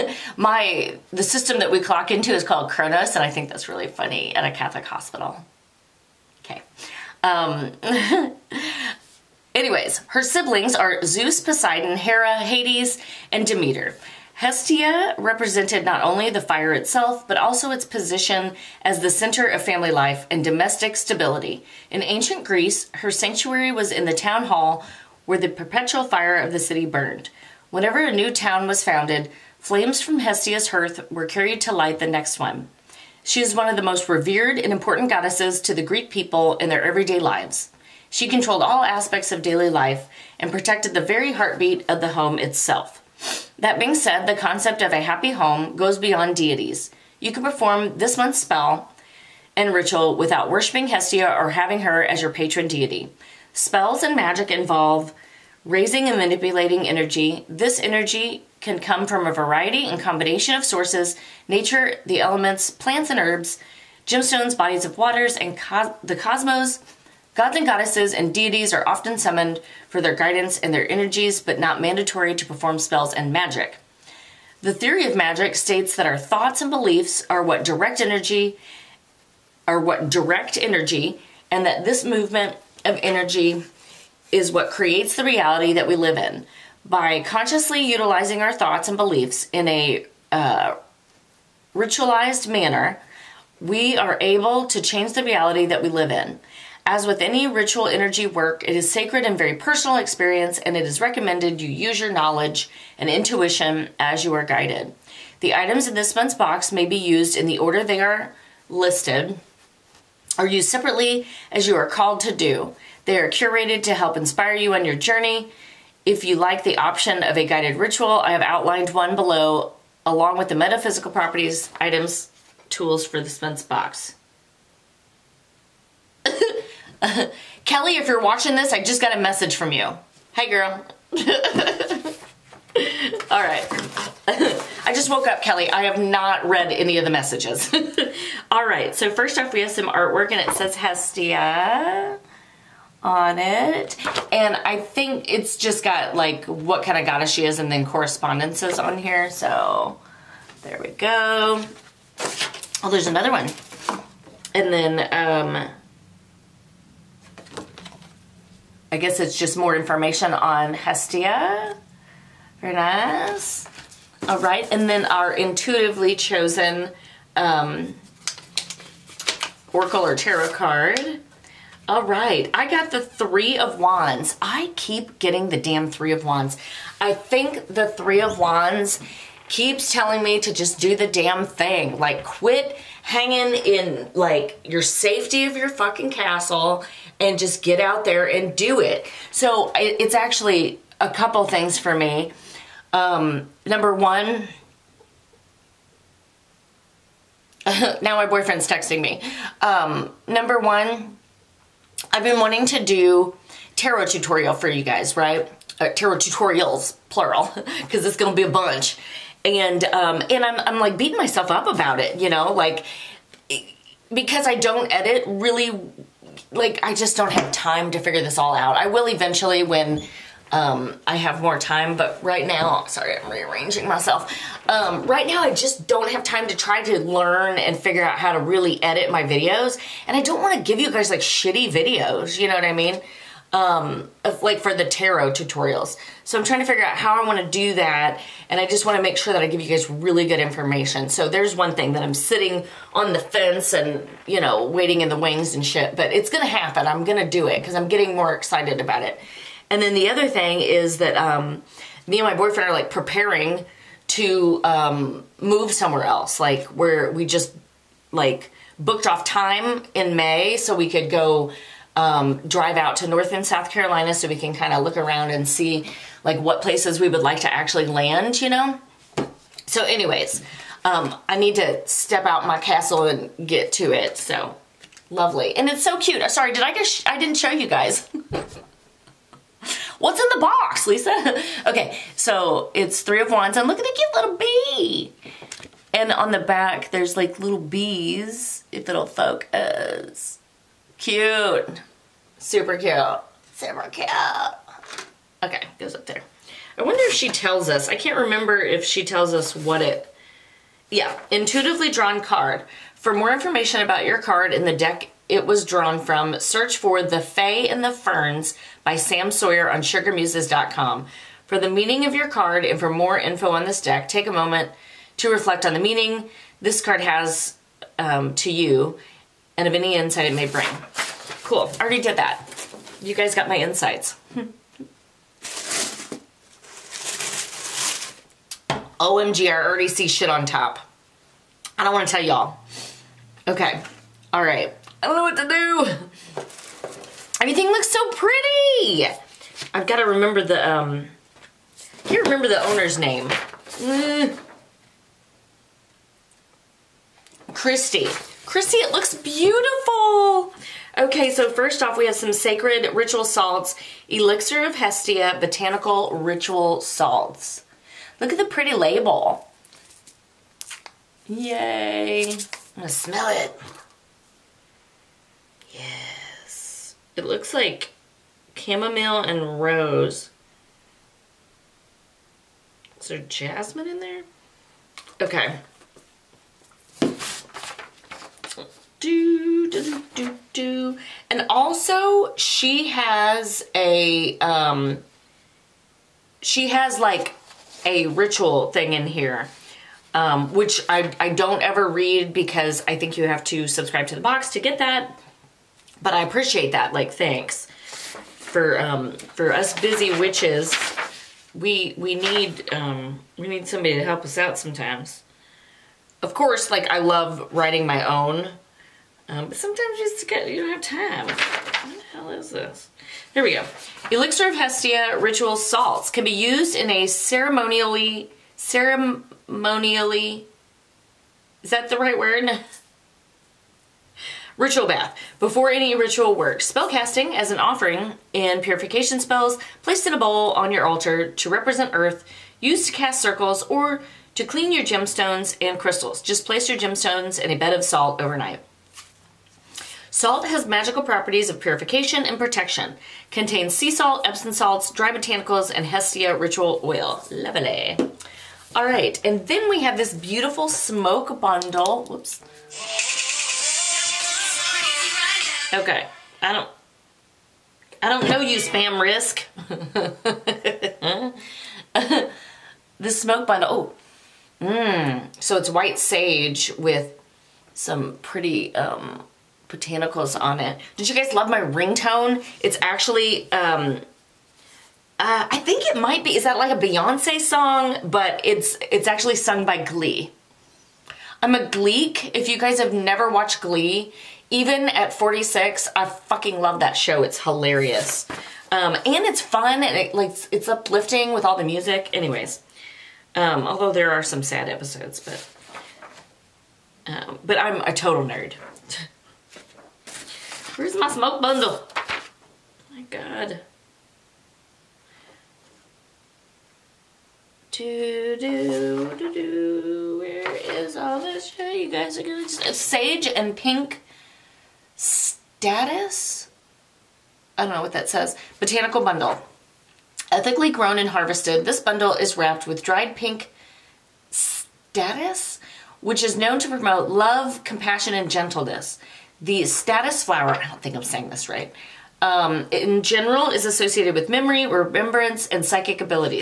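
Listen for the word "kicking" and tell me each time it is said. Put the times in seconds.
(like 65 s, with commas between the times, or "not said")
not said.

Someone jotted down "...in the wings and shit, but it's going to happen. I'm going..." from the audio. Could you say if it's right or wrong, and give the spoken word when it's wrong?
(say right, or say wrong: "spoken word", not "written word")
right.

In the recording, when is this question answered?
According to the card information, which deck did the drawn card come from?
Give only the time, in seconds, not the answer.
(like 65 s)
307 s.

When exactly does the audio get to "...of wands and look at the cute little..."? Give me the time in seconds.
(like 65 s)
283 s.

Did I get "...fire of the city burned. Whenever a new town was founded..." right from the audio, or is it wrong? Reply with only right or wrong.
right.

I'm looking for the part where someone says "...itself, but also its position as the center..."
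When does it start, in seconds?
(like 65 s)
16 s.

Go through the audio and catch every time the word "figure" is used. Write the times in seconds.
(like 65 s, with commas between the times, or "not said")
217 s, 227 s, 236 s.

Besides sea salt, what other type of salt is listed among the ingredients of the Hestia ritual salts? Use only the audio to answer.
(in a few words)
Epsom salts.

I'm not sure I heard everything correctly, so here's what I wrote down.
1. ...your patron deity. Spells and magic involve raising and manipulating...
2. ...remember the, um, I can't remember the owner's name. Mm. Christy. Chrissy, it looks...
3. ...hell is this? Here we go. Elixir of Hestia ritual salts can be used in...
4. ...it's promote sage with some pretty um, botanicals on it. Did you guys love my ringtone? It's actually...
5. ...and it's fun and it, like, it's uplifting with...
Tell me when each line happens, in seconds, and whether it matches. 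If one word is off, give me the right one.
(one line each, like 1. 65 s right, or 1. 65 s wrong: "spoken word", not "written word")
1. 52 s right
2. 340 s right
3. 412 s right
4. 465 s wrong: "white", not "promote"
5. 488 s right.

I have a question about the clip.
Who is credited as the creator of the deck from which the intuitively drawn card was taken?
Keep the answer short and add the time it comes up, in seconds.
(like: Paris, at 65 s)
Sam Sawyer, at 308 s.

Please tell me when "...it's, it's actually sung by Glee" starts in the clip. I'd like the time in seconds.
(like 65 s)
478 s.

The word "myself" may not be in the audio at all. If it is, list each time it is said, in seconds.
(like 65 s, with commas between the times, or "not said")
211 s, 223 s.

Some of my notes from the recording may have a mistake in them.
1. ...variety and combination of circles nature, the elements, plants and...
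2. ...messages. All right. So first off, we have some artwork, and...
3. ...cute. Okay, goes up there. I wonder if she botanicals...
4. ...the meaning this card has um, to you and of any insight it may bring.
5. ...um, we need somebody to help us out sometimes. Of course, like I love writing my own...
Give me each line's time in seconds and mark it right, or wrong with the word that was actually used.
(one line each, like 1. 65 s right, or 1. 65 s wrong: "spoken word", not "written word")
1. 59 s wrong: "sources", not "circles"
2. 137 s right
3. 293 s wrong: "tells", not "botanicals"
4. 315 s right
5. 402 s right.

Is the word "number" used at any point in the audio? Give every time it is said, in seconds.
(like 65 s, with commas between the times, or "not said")
193 s, 200 s.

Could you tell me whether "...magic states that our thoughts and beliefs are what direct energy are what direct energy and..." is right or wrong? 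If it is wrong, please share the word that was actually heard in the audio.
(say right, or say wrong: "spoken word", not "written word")
right.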